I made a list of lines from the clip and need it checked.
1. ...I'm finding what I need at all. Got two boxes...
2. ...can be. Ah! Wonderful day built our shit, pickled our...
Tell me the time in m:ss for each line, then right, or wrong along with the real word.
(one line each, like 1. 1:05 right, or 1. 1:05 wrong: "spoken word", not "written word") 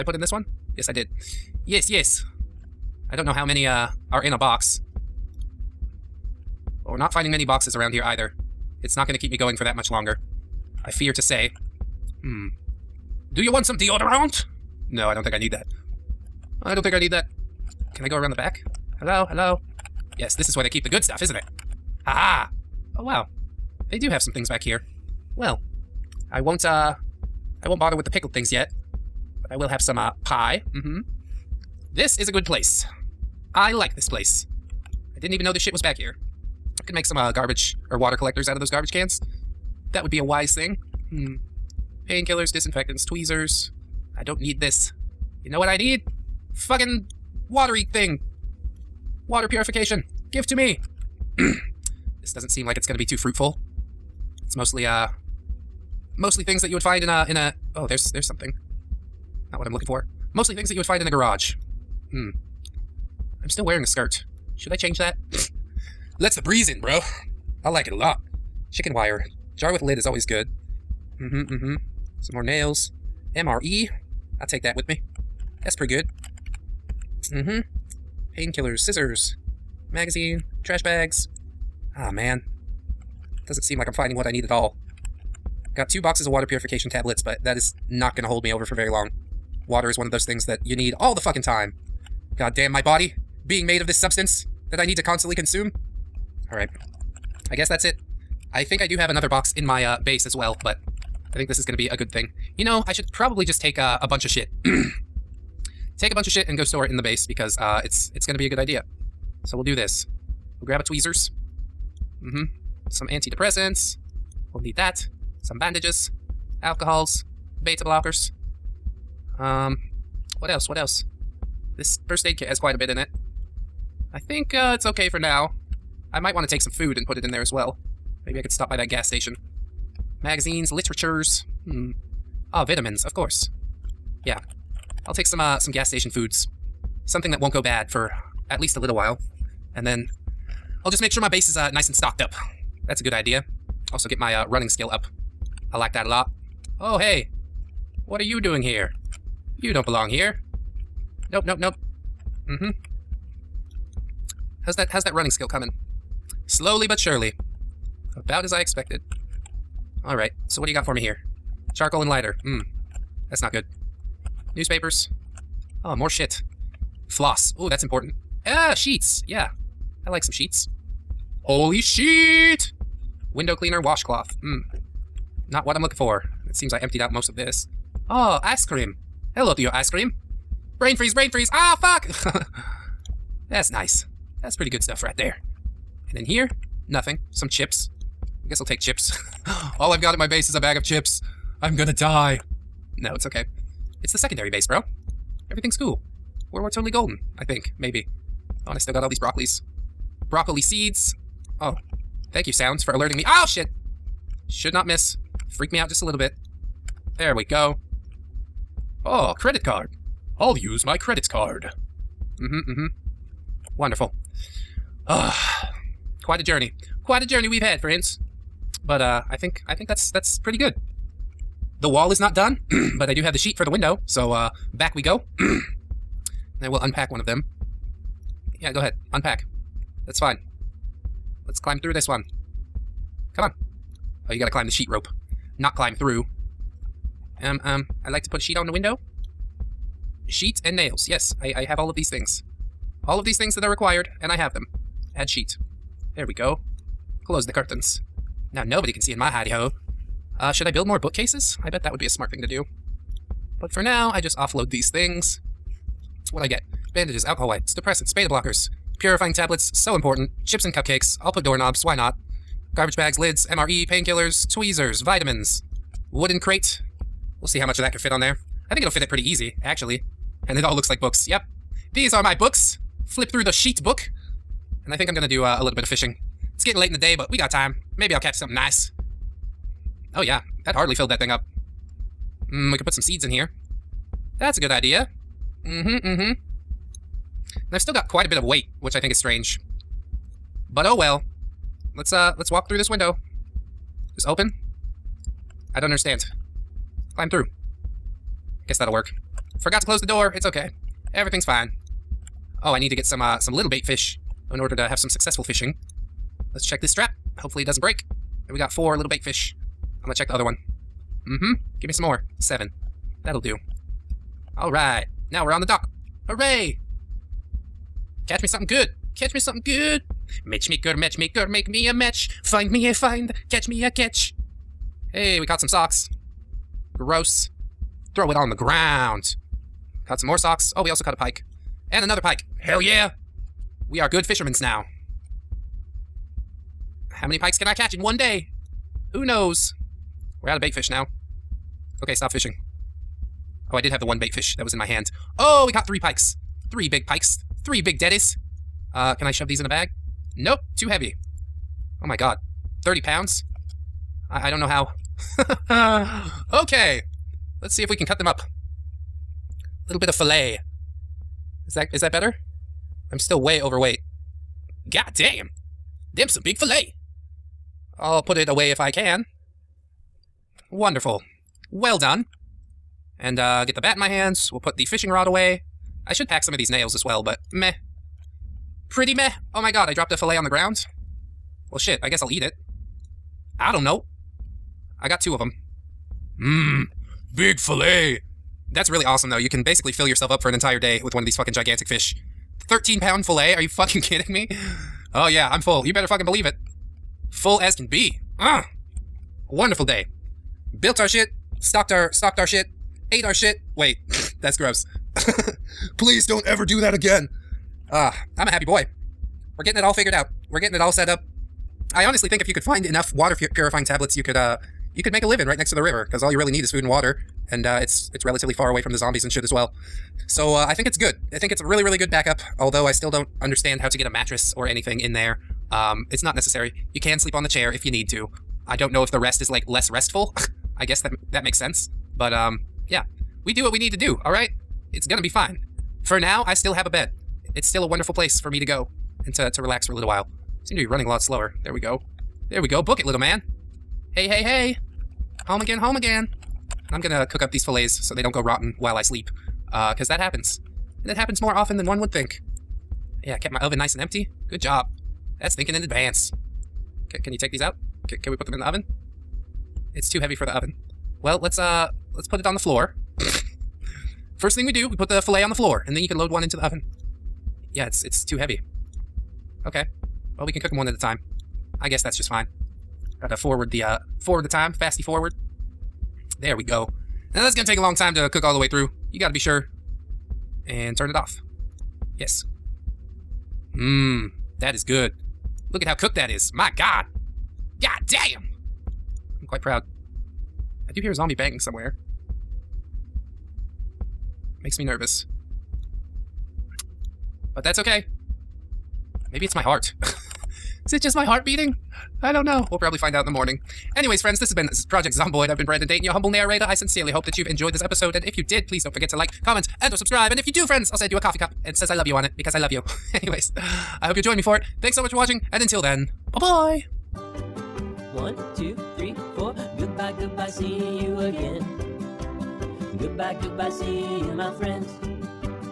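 1. 1:23 right
2. 6:37 wrong: "stocked", not "pickled".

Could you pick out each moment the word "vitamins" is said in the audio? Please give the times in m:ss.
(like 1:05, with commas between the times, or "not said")
2:12, 4:24.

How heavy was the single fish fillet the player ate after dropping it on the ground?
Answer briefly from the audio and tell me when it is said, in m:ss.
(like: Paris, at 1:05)
13 pounds, at 6:32.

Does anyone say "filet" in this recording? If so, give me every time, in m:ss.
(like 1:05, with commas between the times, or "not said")
6:27, 6:33.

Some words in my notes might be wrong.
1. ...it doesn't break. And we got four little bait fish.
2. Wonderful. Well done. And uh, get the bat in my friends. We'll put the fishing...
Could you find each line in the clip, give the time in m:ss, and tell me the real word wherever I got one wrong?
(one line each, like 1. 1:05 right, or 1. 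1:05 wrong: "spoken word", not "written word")
1. 5:07 right
2. 6:10 wrong: "hands", not "friends".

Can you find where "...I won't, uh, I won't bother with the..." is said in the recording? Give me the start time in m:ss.
0:26.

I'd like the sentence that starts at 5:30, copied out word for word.
Oh, we also caught a pike.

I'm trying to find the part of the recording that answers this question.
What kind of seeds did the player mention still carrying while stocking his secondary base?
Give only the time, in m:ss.
3:20.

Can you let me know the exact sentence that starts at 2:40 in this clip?
Alright, so what do you got for me here?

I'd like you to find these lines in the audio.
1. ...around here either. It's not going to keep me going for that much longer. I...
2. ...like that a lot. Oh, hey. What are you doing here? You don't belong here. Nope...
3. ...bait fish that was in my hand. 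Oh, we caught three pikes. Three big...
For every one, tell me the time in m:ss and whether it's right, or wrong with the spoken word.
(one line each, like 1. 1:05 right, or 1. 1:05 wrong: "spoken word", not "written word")
1. 0:07 right
2. 2:25 right
3. 5:44 right.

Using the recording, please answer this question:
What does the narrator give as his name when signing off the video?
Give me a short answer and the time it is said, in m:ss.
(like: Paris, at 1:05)
Brandon Dayton, at 8:25.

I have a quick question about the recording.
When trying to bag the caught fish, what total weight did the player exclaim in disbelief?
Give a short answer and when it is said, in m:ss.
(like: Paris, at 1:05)
30 pounds, at 5:52.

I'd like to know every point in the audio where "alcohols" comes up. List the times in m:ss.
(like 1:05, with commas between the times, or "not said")
1:56, 4:17.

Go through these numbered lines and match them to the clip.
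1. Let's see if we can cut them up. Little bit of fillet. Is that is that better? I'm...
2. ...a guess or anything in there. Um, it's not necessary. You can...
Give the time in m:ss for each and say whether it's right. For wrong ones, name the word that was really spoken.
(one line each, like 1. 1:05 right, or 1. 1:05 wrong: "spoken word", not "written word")
1. 5:57 right
2. 7:04 wrong: "mattress", not "guess".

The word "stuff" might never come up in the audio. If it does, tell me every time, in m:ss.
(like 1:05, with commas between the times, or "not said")
0:21, 3:04.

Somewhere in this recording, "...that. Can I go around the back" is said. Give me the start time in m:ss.
0:17.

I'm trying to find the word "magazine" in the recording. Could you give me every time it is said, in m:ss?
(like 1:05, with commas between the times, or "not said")
1:19, 2:10.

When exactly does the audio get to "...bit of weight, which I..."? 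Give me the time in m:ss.
4:48.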